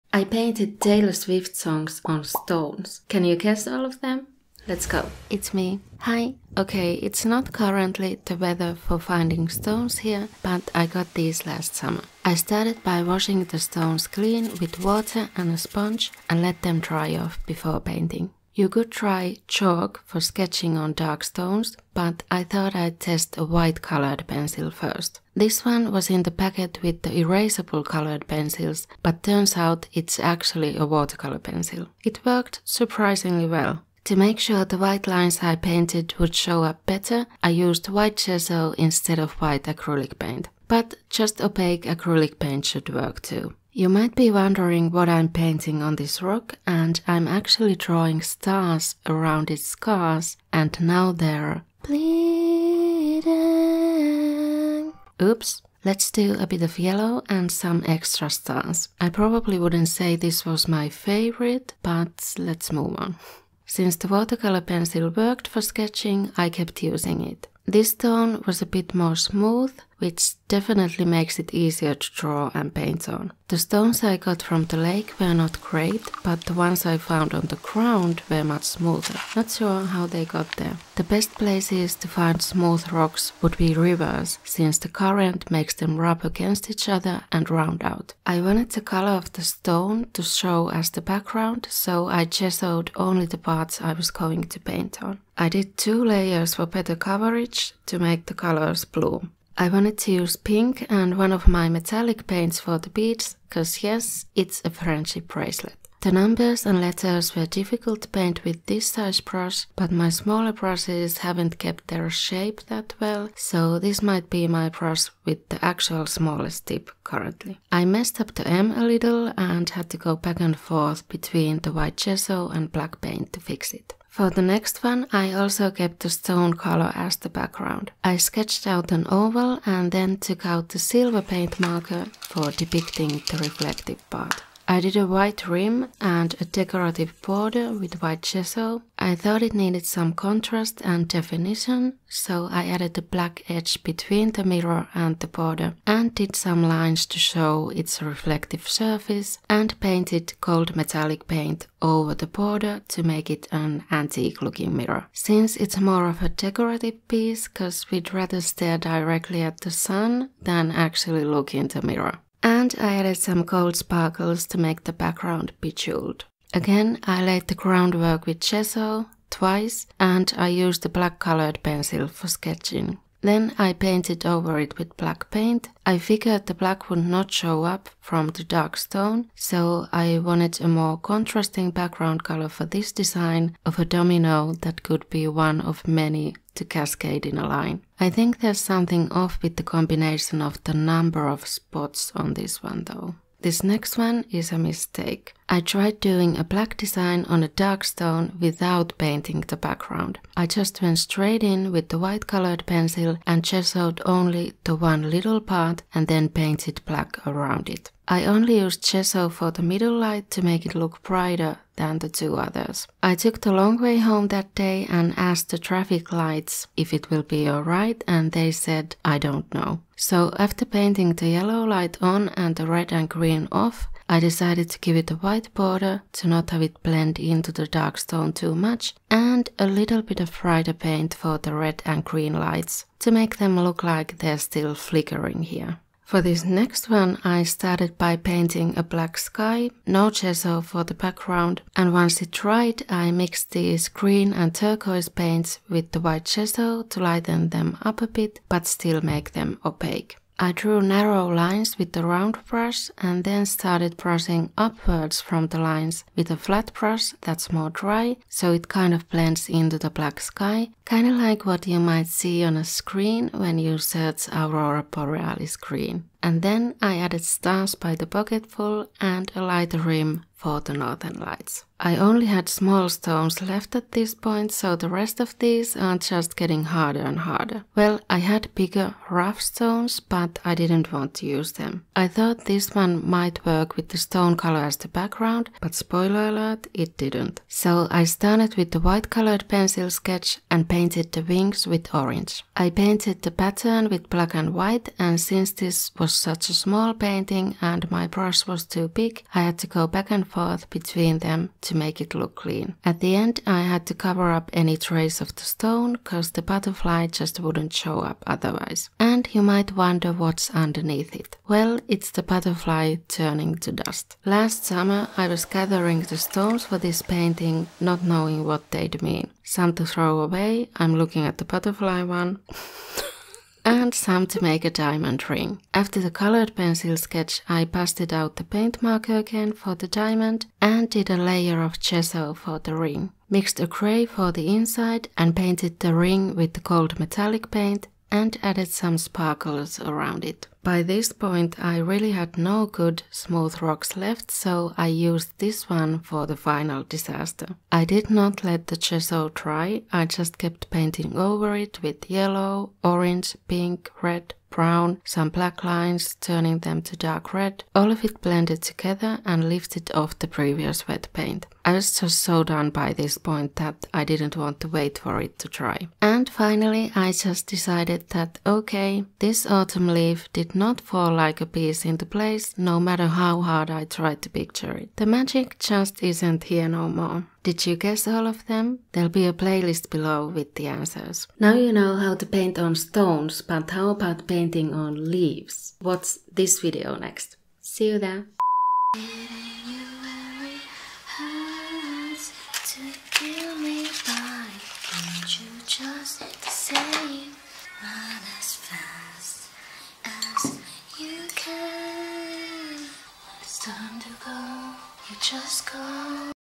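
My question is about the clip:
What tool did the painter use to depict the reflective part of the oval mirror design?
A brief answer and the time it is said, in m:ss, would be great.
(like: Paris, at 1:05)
silver paint marker, at 2:10.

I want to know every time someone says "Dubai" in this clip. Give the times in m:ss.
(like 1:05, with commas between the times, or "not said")
not said.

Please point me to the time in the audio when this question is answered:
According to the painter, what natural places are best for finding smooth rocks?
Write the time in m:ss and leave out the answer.
1:23.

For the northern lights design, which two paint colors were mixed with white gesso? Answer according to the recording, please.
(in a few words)
green and turquoise.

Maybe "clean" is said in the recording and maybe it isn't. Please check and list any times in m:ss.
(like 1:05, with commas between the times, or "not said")
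0:14, 5:02.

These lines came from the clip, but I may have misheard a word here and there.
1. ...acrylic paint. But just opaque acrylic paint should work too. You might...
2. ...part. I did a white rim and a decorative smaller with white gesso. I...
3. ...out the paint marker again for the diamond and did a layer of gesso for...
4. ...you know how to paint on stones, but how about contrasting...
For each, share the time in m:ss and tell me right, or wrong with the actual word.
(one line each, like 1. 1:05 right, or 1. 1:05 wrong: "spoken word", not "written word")
1. 0:39 right
2. 2:14 wrong: "border", not "smaller"
3. 5:28 right
4. 6:21 wrong: "painting", not "contrasting".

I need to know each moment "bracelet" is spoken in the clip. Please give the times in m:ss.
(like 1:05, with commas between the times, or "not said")
1:45.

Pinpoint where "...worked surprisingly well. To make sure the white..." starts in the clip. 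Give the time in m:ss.
0:32.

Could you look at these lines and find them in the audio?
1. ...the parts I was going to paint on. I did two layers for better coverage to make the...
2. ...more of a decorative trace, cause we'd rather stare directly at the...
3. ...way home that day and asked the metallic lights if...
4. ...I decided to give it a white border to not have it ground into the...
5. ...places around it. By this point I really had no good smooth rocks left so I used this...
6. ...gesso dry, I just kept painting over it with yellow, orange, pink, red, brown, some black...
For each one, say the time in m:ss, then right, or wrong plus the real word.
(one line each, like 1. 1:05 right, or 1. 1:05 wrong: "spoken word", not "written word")
1. 1:33 right
2. 2:35 wrong: "piece", not "trace"
3. 3:33 wrong: "traffic", not "metallic"
4. 3:44 wrong: "blend", not "ground"
5. 5:38 wrong: "sparkles", not "places"
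6. 5:48 right.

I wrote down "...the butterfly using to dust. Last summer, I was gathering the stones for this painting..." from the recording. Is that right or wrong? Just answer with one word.
wrong.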